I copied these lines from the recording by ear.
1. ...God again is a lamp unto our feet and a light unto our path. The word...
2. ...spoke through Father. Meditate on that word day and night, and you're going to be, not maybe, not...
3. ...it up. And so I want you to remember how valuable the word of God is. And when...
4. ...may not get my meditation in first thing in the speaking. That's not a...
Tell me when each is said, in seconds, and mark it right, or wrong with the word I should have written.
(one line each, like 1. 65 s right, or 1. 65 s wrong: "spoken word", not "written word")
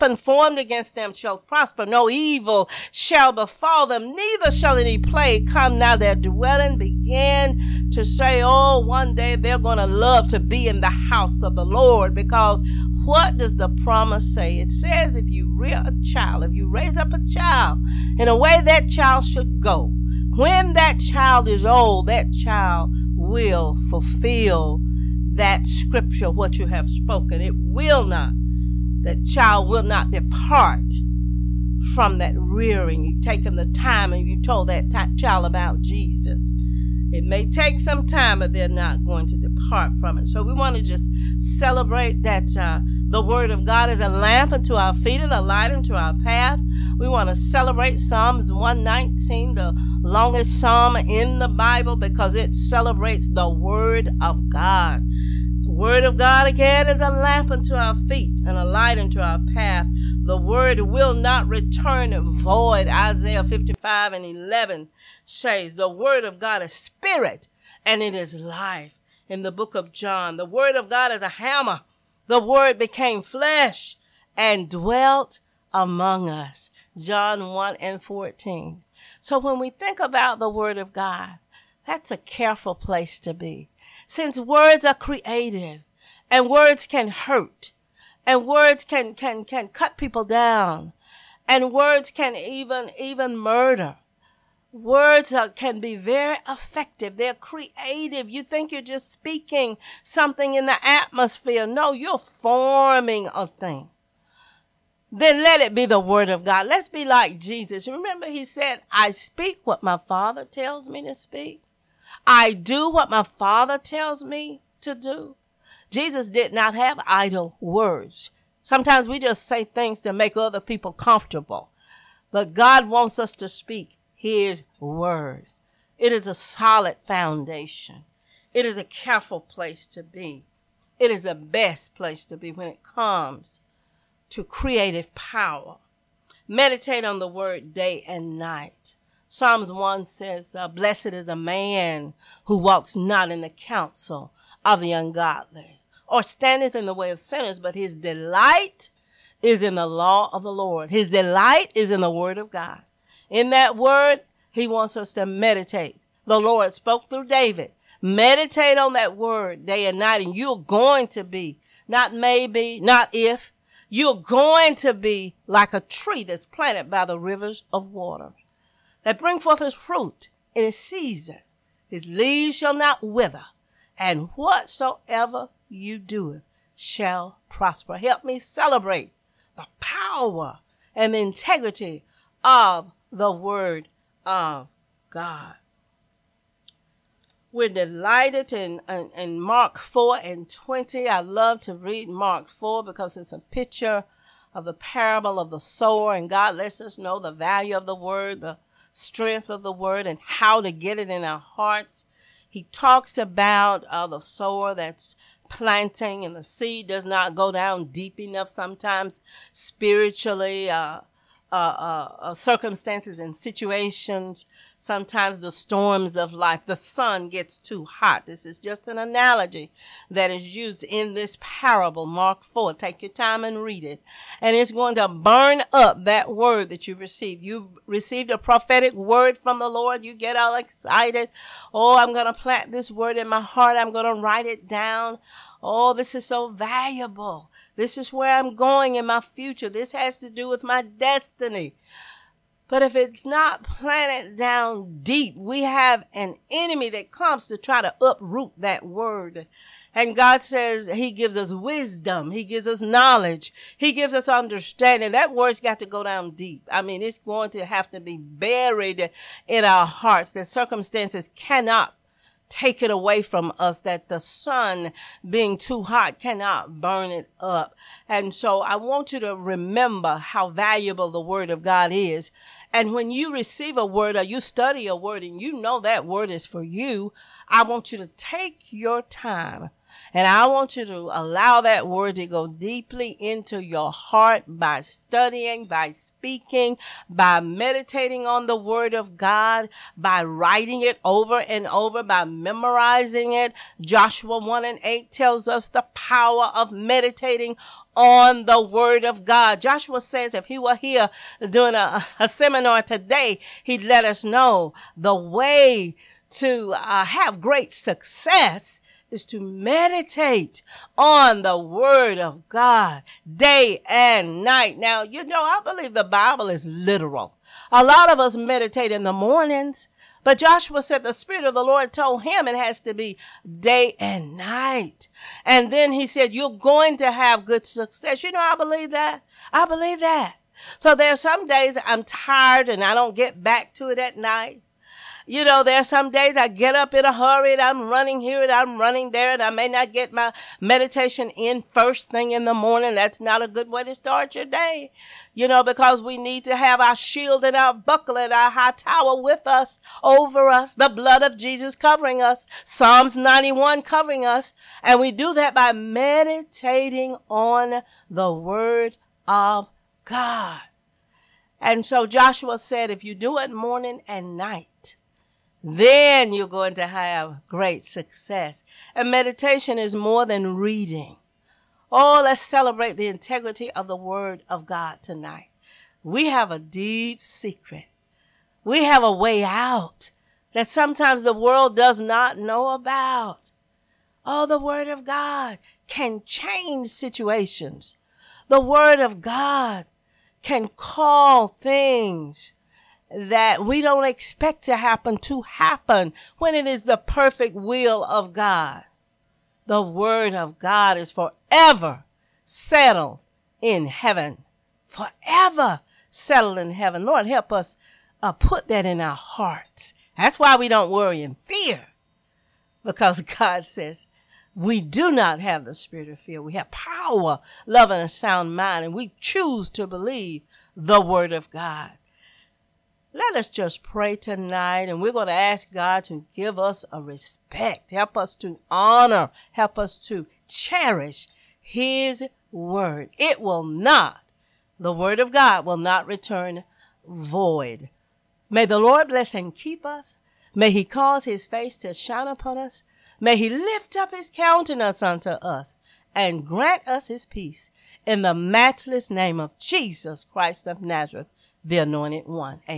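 1. 56 s right
2. 156 s wrong: "David", not "Father"
3. 267 s right
4. 339 s wrong: "morning", not "speaking".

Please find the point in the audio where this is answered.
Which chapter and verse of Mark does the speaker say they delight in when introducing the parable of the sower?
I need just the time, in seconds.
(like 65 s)
189 s.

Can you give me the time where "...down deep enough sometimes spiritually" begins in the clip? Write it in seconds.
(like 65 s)
207 s.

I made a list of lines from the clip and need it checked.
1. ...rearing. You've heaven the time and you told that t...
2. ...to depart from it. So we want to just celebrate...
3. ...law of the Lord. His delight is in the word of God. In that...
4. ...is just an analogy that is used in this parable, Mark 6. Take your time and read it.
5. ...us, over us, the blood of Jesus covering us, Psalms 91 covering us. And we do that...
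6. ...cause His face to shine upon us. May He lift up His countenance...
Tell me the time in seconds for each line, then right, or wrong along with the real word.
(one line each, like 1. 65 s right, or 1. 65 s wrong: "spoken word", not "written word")
1. 32 s wrong: "taken", not "heaven"
2. 39 s right
3. 149 s right
4. 218 s wrong: "4", not "6"
5. 349 s right
6. 440 s right.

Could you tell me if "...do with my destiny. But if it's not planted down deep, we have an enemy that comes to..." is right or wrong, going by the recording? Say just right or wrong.
right.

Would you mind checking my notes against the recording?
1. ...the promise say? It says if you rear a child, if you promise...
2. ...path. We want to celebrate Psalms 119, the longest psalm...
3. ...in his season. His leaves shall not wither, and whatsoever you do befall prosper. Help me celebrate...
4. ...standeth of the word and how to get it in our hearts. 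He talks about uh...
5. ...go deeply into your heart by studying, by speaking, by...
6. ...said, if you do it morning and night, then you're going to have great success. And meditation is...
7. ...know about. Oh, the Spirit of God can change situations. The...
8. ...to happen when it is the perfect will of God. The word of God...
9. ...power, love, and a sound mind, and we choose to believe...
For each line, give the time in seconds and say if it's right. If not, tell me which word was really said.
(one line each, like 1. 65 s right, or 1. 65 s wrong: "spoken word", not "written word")
1. 13 s wrong: "raise", not "promise"
2. 46 s right
3. 170 s wrong: "shall", not "befall"
4. 198 s wrong: "strength", not "standeth"
5. 282 s right
6. 362 s right
7. 382 s wrong: "Word", not "Spirit"
8. 395 s right
9. 416 s right.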